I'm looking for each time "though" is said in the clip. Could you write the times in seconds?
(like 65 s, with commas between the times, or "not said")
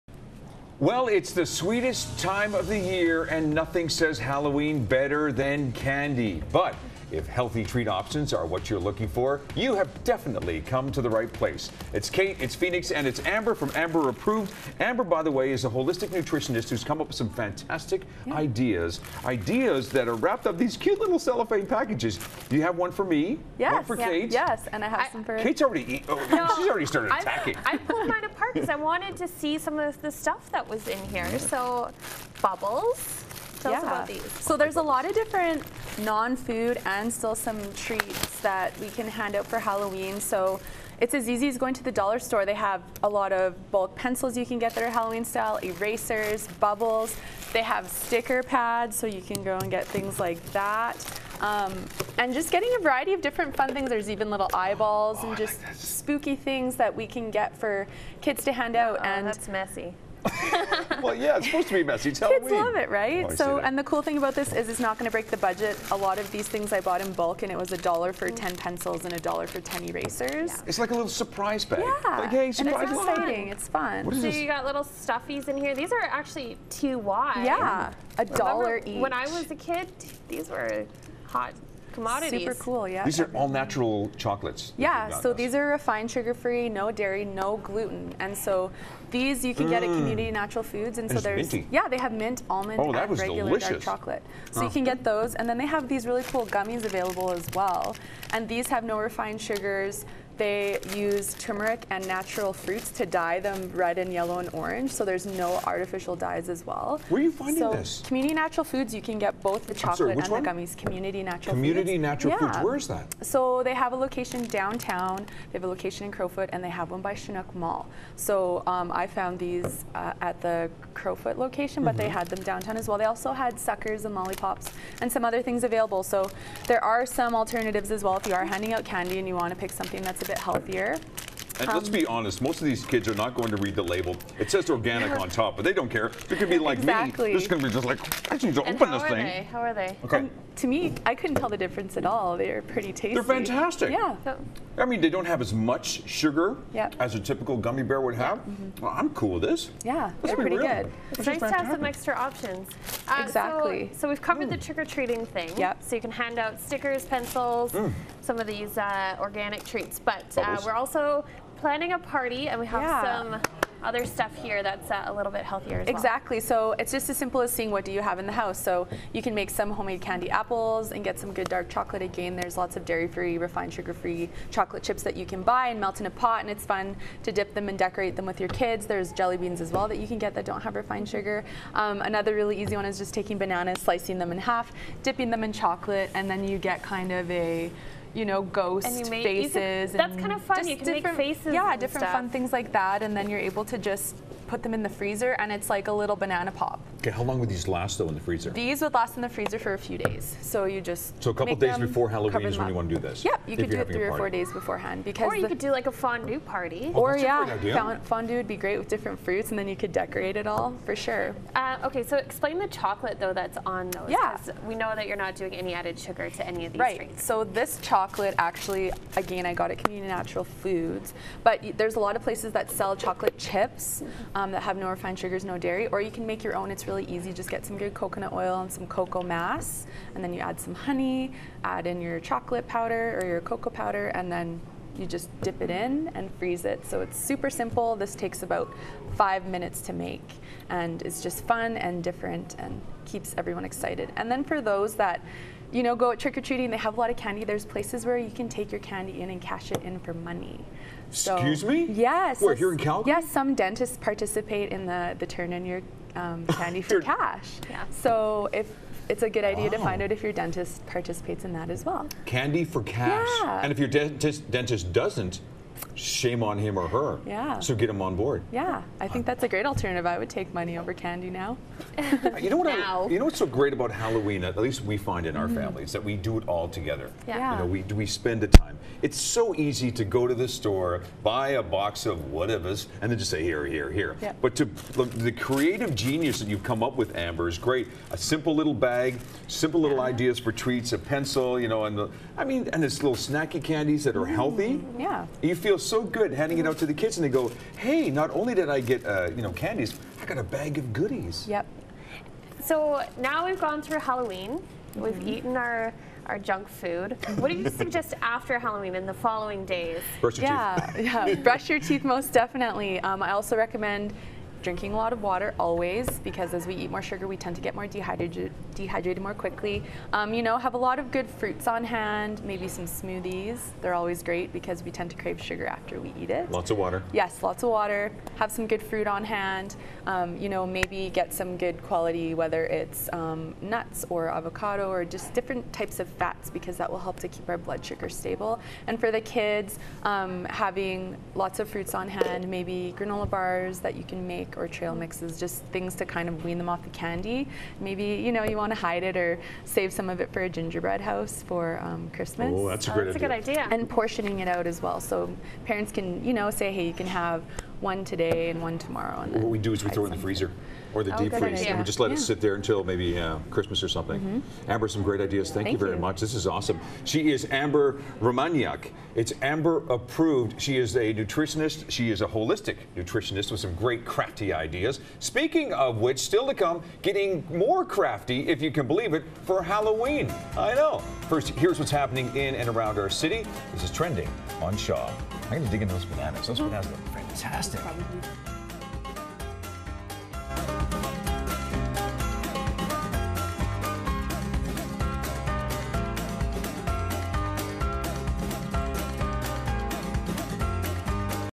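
197 s, 213 s.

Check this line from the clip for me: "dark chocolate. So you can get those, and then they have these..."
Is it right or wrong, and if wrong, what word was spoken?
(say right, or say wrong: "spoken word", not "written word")
right.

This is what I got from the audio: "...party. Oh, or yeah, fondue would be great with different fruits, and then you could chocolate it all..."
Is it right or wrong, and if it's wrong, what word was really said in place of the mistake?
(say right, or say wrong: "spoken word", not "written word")
wrong: "decorate", not "chocolate".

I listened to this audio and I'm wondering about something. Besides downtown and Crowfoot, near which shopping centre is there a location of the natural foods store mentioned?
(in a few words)
Chinook Mall.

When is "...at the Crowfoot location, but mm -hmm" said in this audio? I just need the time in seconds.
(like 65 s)
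120 s.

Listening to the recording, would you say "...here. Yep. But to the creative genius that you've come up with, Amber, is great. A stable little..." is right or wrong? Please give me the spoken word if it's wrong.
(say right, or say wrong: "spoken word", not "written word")
wrong: "simple", not "stable".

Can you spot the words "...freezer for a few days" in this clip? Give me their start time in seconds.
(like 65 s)
199 s.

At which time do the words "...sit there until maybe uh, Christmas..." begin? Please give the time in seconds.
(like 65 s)
362 s.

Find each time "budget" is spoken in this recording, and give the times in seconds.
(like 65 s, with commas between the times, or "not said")
65 s.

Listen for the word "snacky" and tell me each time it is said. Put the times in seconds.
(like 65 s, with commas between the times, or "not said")
293 s.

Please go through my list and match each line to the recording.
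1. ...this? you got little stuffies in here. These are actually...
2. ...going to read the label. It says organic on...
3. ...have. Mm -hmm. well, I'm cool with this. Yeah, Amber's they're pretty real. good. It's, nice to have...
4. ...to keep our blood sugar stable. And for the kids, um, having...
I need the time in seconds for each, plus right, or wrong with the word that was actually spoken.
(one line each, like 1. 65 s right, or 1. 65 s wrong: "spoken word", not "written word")
1. 74 s right
2. 133 s right
3. 148 s wrong: "Let", not "Amber"
4. 337 s right.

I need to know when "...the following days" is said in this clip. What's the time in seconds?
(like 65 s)
309 s.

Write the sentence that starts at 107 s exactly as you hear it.
Where are you finding so this?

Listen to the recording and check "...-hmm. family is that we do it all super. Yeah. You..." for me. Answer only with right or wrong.
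wrong.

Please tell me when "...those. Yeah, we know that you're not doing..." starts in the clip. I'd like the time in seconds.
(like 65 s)
213 s.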